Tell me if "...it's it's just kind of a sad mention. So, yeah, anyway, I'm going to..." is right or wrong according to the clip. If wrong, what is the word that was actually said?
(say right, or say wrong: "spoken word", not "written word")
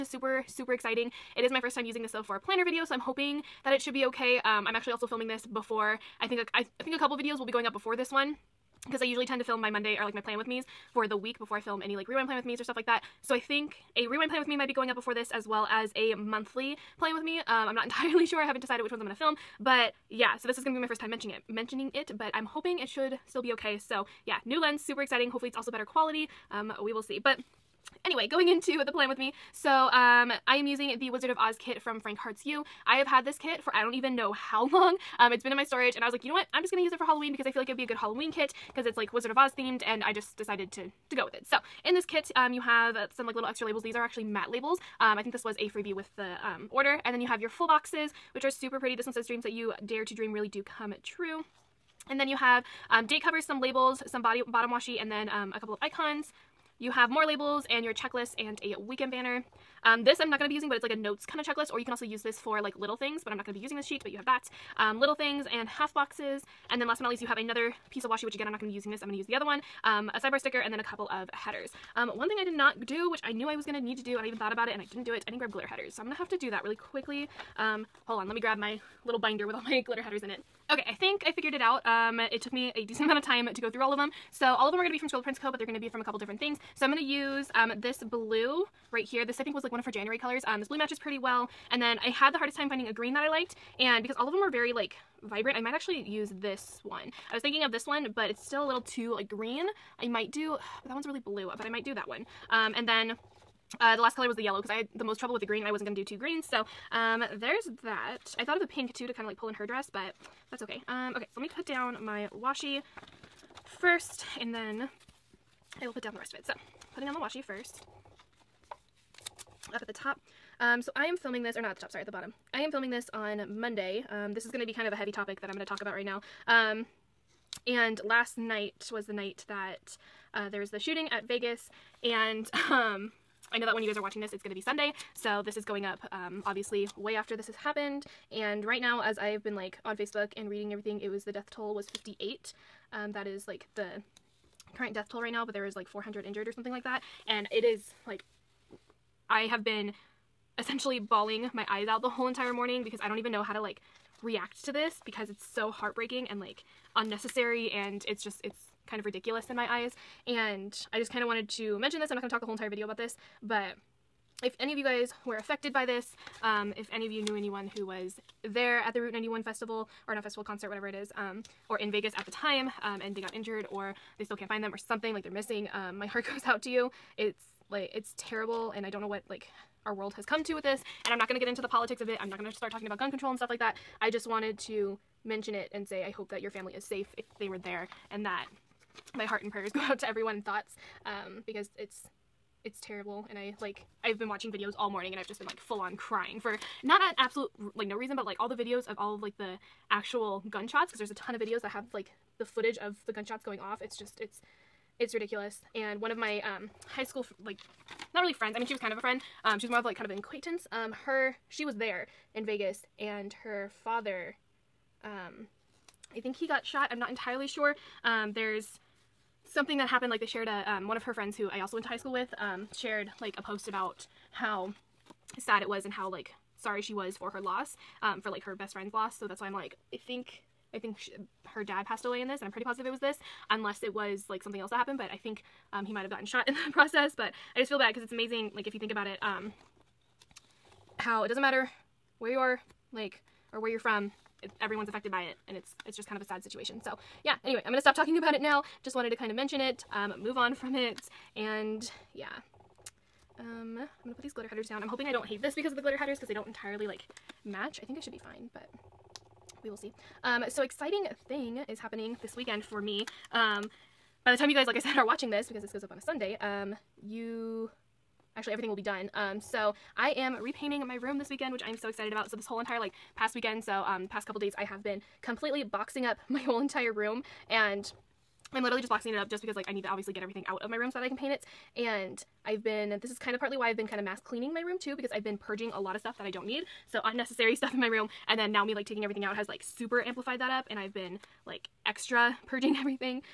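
wrong: "situation", not "mention".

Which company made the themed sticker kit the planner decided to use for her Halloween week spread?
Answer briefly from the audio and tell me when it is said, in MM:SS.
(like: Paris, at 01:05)
Frank Hearts You, at 00:31.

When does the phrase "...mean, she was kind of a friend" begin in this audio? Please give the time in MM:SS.
03:28.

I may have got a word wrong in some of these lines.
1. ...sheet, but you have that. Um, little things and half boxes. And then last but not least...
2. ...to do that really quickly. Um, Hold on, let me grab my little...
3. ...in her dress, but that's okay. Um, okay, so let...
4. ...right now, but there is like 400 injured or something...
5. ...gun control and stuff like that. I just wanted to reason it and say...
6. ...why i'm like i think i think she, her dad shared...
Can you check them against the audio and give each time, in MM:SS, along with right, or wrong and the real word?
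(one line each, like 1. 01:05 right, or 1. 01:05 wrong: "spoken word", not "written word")
1. 01:03 right
2. 01:16 right
3. 01:49 right
4. 02:25 right
5. 03:02 wrong: "mention", not "reason"
6. 03:49 wrong: "passed", not "shared".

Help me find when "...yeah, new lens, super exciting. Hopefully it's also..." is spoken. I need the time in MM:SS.
00:24.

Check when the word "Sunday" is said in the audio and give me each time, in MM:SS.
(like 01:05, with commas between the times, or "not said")
02:14, 04:25.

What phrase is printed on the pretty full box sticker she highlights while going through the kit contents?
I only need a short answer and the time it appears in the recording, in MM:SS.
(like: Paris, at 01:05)
Dreams that you dare to dream really do come true, at 00:49.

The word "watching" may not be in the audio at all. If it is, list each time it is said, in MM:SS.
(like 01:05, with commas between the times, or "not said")
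02:14, 03:14, 04:25.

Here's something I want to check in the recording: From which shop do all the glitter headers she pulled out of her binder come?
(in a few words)
Scribble Prints Co.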